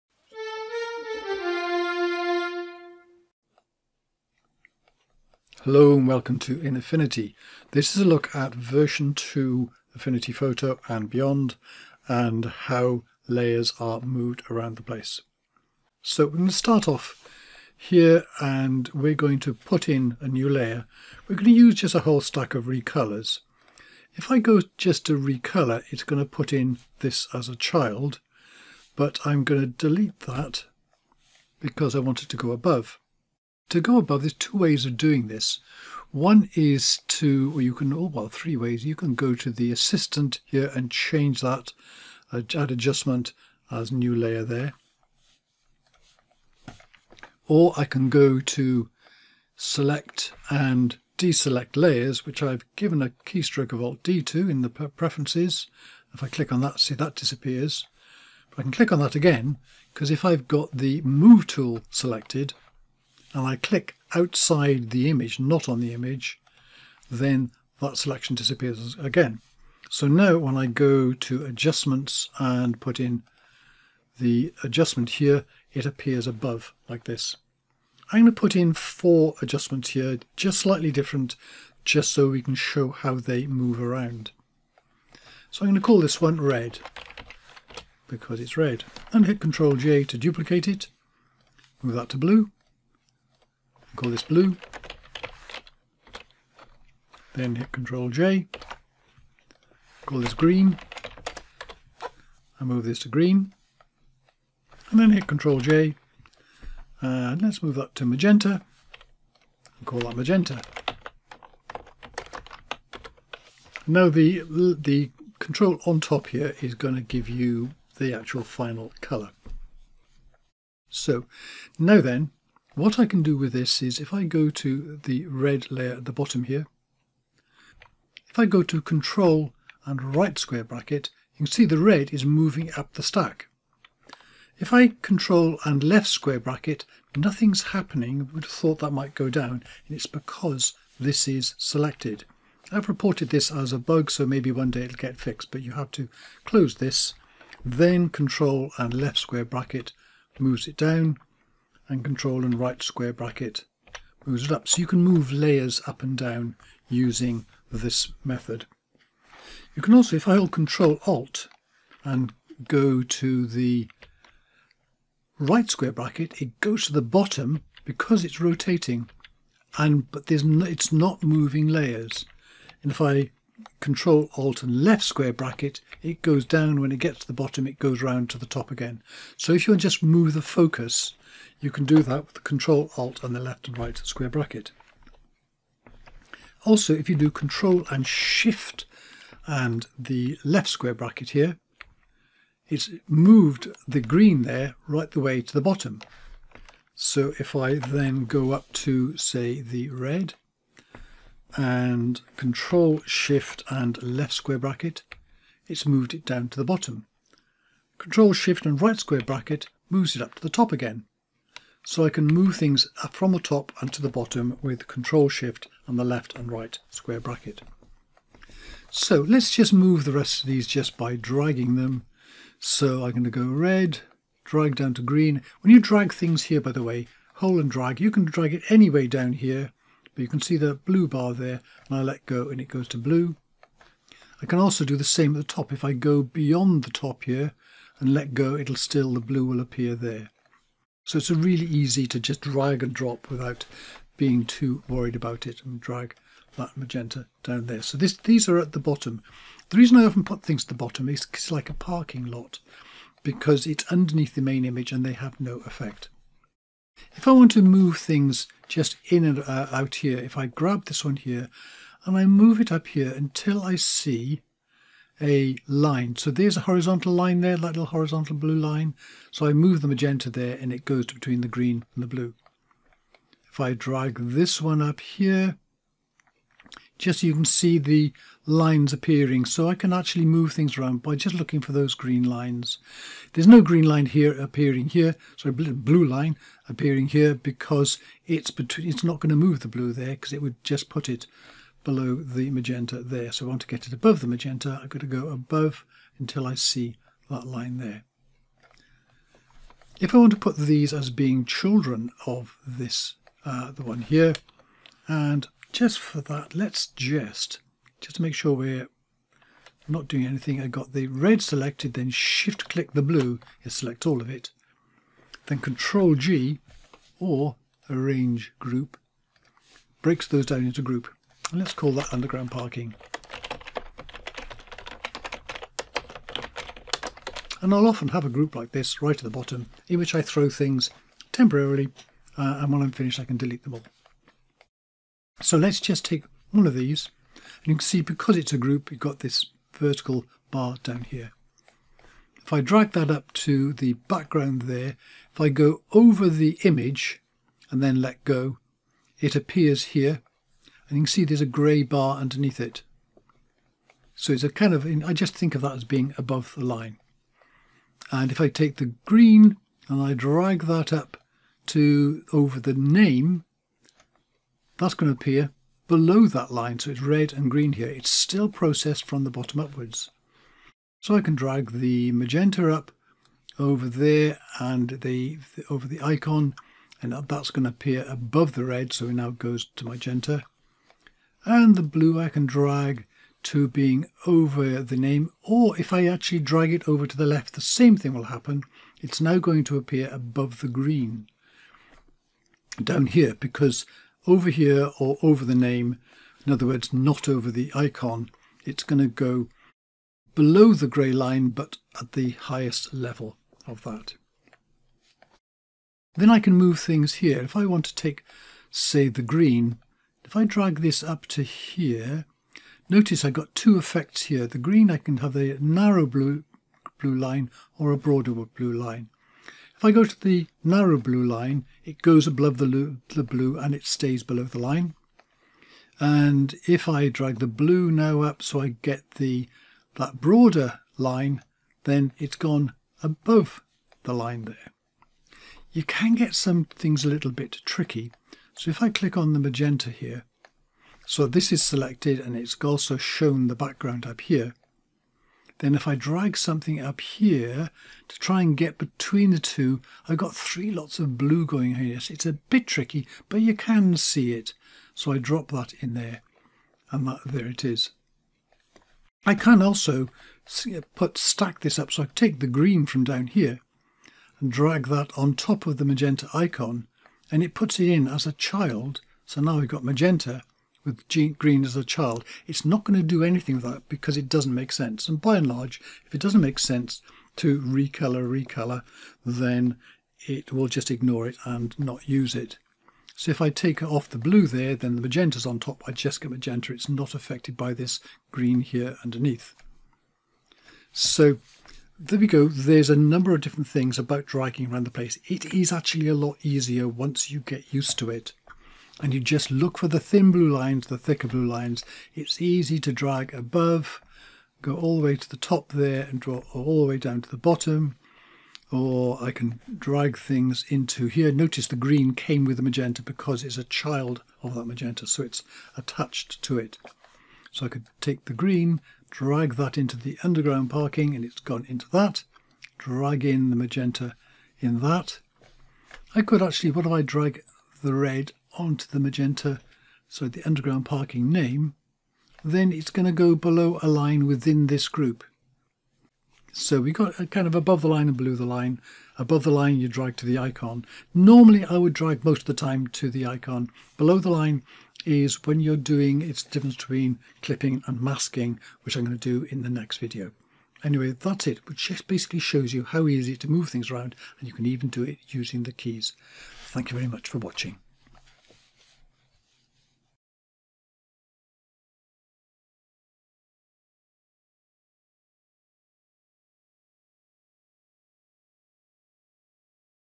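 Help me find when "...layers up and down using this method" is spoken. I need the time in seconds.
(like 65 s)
155 s.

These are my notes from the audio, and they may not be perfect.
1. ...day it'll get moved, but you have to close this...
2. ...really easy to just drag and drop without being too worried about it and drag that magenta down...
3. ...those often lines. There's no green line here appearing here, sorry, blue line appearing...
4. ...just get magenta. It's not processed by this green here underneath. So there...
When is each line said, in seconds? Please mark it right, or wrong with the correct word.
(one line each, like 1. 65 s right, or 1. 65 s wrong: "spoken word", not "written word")
1. 144 s wrong: "fixed", not "moved"
2. 241 s right
3. 281 s wrong: "green", not "often"
4. 485 s wrong: "affected", not "processed".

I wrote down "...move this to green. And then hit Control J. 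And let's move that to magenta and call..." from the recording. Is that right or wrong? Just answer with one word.
right.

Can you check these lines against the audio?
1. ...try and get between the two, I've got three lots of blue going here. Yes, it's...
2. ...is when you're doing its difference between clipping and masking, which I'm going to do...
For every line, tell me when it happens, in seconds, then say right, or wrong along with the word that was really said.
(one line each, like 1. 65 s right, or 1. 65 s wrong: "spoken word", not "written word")
1. 448 s right
2. 545 s right.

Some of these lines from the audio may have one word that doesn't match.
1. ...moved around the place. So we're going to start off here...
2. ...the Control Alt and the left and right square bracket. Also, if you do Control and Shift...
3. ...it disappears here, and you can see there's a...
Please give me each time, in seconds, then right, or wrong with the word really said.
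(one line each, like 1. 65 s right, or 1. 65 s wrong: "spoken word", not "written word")
1. 14 s right
2. 182 s right
3. 349 s wrong: "appears", not "disappears".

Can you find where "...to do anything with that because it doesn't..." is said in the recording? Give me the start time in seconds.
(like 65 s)
472 s.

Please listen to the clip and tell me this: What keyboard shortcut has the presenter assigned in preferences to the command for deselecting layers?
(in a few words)
Alt D.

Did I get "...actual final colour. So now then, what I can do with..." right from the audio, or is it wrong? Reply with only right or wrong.
right.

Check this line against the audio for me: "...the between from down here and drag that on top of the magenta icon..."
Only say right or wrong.
wrong.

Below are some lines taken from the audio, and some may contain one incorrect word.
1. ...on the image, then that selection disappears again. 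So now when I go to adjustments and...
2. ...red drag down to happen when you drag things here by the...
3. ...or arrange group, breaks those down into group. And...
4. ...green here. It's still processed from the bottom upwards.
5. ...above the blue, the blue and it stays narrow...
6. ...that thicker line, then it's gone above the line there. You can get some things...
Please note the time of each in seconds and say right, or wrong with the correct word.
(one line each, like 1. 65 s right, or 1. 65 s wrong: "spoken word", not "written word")
1. 65 s right
2. 223 s wrong: "green", not "happen"
3. 317 s right
4. 367 s right
5. 422 s wrong: "below", not "narrow"
6. 429 s wrong: "broader", not "thicker".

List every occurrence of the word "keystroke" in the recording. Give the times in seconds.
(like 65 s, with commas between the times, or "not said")
53 s.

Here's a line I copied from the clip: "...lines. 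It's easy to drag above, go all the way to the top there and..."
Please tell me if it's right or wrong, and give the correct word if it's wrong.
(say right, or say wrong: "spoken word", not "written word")
right.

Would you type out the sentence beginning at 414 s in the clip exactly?
The green, I can have a narrow blue, blue line or a broader blue line.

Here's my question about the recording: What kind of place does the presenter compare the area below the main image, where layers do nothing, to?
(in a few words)
parking lot.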